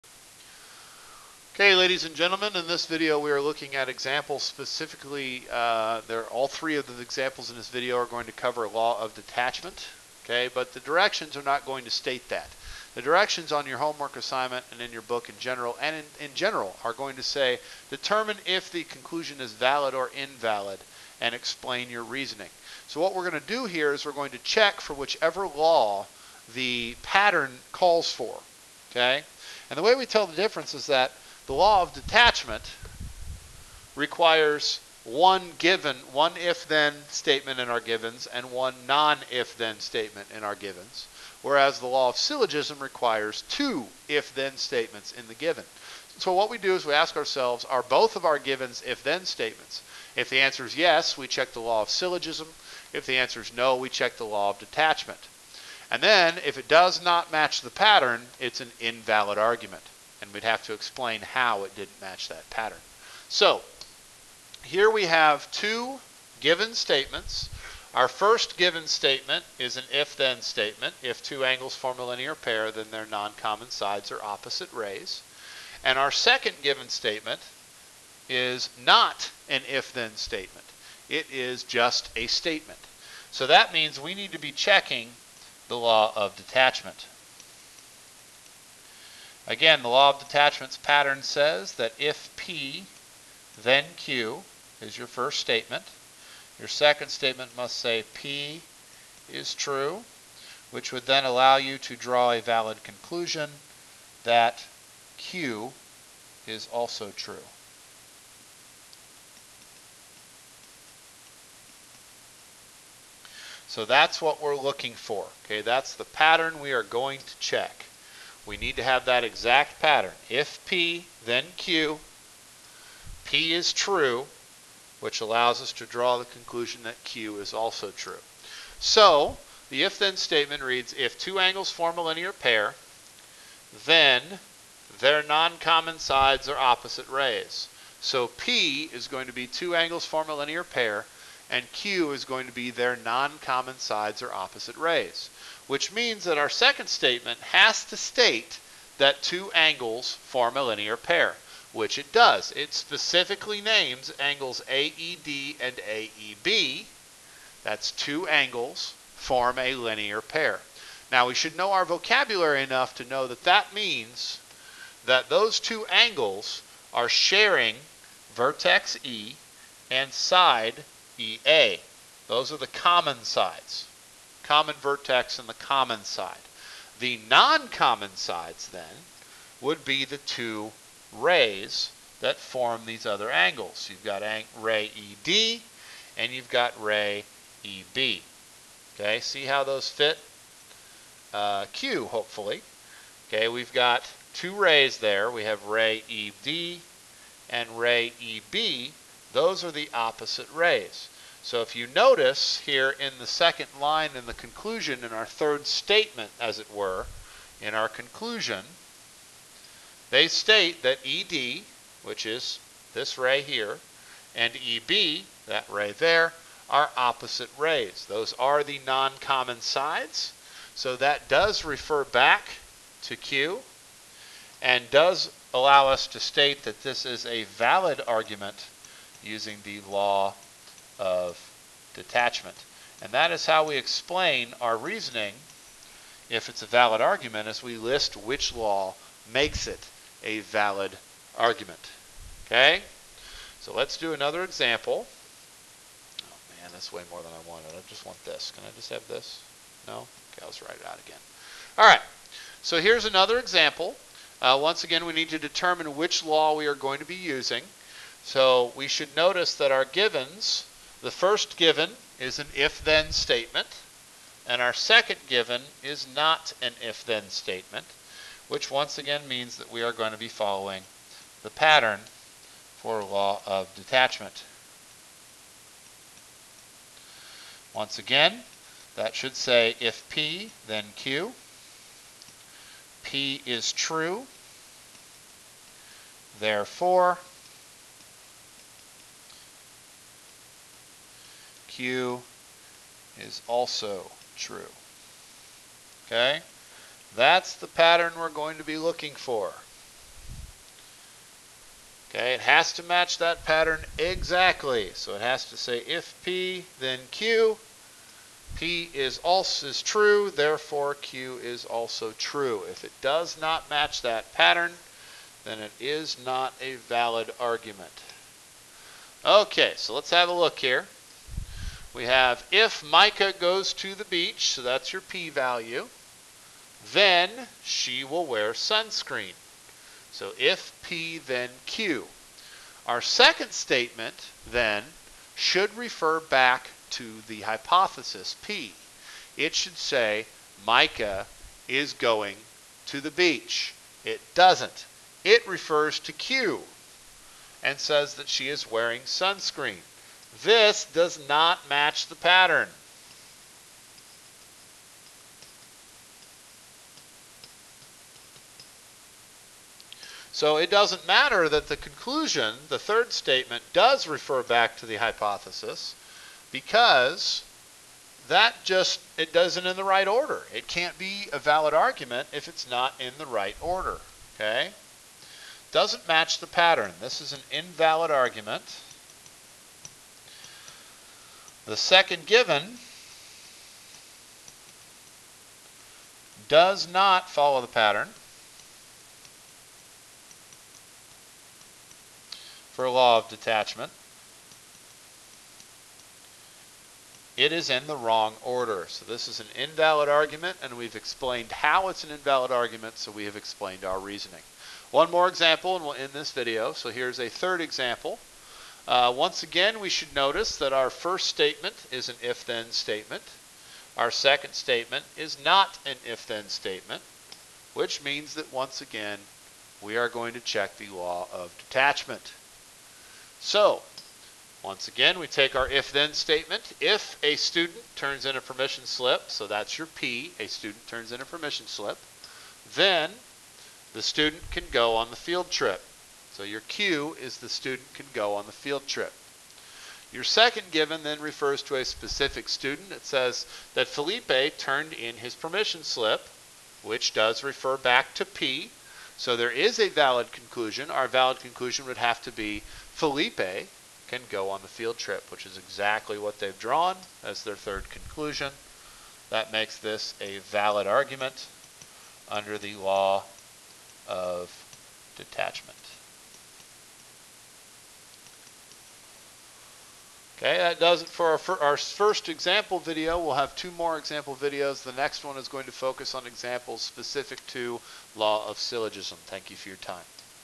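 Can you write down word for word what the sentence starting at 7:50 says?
Okay, that does it for our, for our, first example video.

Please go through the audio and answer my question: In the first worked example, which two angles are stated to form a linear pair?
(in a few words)
AED and AEB.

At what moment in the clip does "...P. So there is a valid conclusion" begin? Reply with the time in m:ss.
7:28.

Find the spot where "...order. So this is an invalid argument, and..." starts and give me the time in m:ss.
6:38.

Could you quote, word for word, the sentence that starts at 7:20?
Your second given then refers to a specific student.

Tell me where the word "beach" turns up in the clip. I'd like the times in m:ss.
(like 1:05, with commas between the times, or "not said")
5:24, 5:43.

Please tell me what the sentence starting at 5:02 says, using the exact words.
Okay, it has to match that pattern exactly.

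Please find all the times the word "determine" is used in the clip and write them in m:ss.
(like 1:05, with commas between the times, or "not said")
0:17, 4:15.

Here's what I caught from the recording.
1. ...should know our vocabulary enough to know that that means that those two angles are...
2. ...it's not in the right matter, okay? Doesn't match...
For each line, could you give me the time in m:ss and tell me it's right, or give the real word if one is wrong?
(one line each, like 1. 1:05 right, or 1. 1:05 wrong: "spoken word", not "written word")
1. 2:41 right
2. 6:12 wrong: "order", not "matter".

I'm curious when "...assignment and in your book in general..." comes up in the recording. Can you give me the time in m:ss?
0:14.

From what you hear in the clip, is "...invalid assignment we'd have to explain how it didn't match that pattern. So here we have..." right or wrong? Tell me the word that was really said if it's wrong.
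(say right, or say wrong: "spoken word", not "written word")
wrong: "argument", not "assignment".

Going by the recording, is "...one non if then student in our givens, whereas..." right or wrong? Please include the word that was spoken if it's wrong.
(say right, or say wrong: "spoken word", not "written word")
wrong: "statement", not "student".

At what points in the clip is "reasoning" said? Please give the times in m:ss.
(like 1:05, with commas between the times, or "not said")
0:22, 3:54, 6:43.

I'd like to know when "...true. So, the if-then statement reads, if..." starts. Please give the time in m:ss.
2:07.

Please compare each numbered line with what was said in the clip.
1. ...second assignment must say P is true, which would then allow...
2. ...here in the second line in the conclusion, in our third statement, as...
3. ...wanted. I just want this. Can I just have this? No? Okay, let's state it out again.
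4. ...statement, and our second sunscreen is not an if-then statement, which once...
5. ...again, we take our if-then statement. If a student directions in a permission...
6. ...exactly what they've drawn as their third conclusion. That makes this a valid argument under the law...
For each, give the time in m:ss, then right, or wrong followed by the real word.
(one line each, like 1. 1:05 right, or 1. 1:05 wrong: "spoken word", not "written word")
1. 1:36 wrong: "statement", not "assignment"
2. 3:22 right
3. 4:07 wrong: "write", not "state"
4. 4:23 wrong: "given", not "sunscreen"
5. 7:04 wrong: "turns", not "directions"
6. 7:35 right.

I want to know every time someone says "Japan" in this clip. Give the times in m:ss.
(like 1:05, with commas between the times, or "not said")
not said.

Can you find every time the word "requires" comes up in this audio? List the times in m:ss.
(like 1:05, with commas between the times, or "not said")
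0:33, 0:42.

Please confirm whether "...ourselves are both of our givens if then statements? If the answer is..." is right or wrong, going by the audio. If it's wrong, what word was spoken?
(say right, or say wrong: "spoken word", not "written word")
right.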